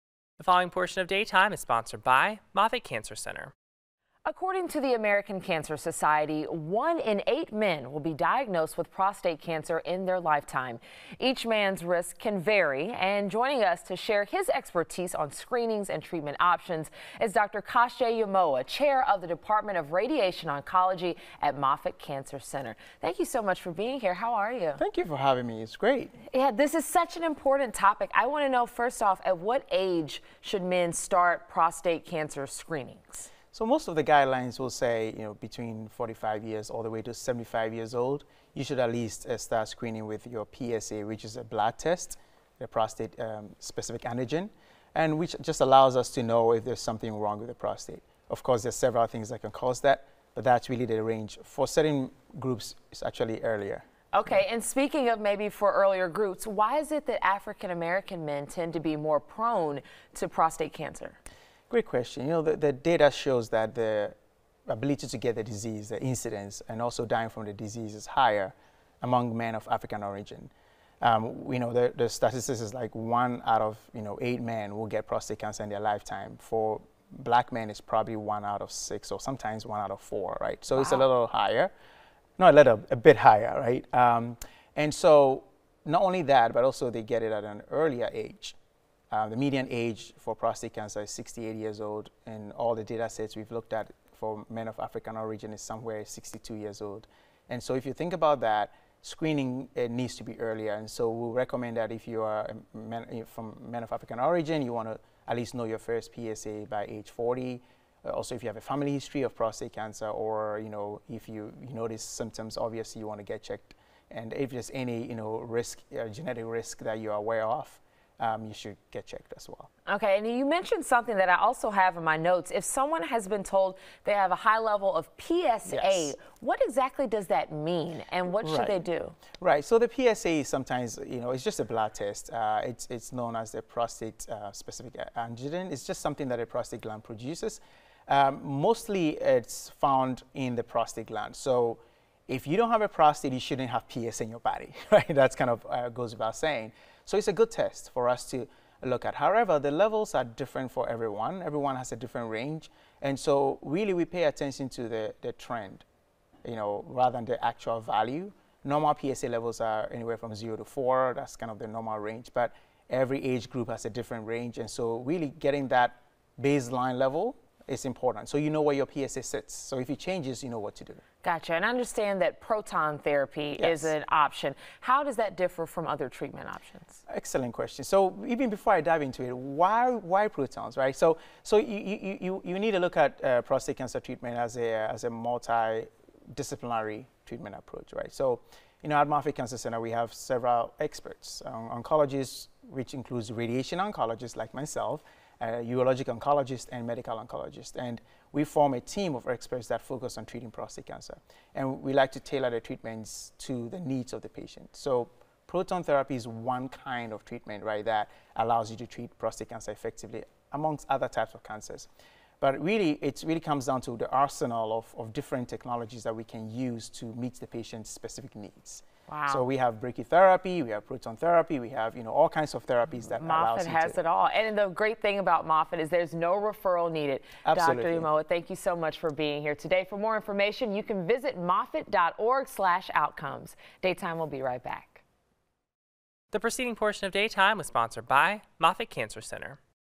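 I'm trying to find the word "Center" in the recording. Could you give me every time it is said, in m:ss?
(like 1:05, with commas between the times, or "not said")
0:03, 0:22, 3:09, 3:59.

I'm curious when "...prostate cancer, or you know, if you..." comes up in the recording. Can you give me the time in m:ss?
1:49.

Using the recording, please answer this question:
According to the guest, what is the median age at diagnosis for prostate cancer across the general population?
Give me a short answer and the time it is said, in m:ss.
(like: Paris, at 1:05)
68, at 1:31.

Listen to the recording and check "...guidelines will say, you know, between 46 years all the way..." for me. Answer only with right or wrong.
wrong.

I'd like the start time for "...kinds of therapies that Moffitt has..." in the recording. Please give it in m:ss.
3:42.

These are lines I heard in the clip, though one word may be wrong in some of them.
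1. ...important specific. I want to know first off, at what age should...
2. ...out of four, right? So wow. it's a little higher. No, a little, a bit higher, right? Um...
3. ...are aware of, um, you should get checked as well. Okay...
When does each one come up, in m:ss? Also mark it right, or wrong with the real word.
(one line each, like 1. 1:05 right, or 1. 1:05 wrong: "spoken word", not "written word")
1. 0:27 wrong: "topic", not "specific"
2. 1:19 right
3. 1:57 right.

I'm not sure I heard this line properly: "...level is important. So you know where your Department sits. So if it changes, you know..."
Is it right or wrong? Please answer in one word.
wrong.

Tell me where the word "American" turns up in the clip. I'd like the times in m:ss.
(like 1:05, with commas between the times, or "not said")
0:04, 0:57.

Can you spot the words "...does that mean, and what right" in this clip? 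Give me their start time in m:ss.
2:07.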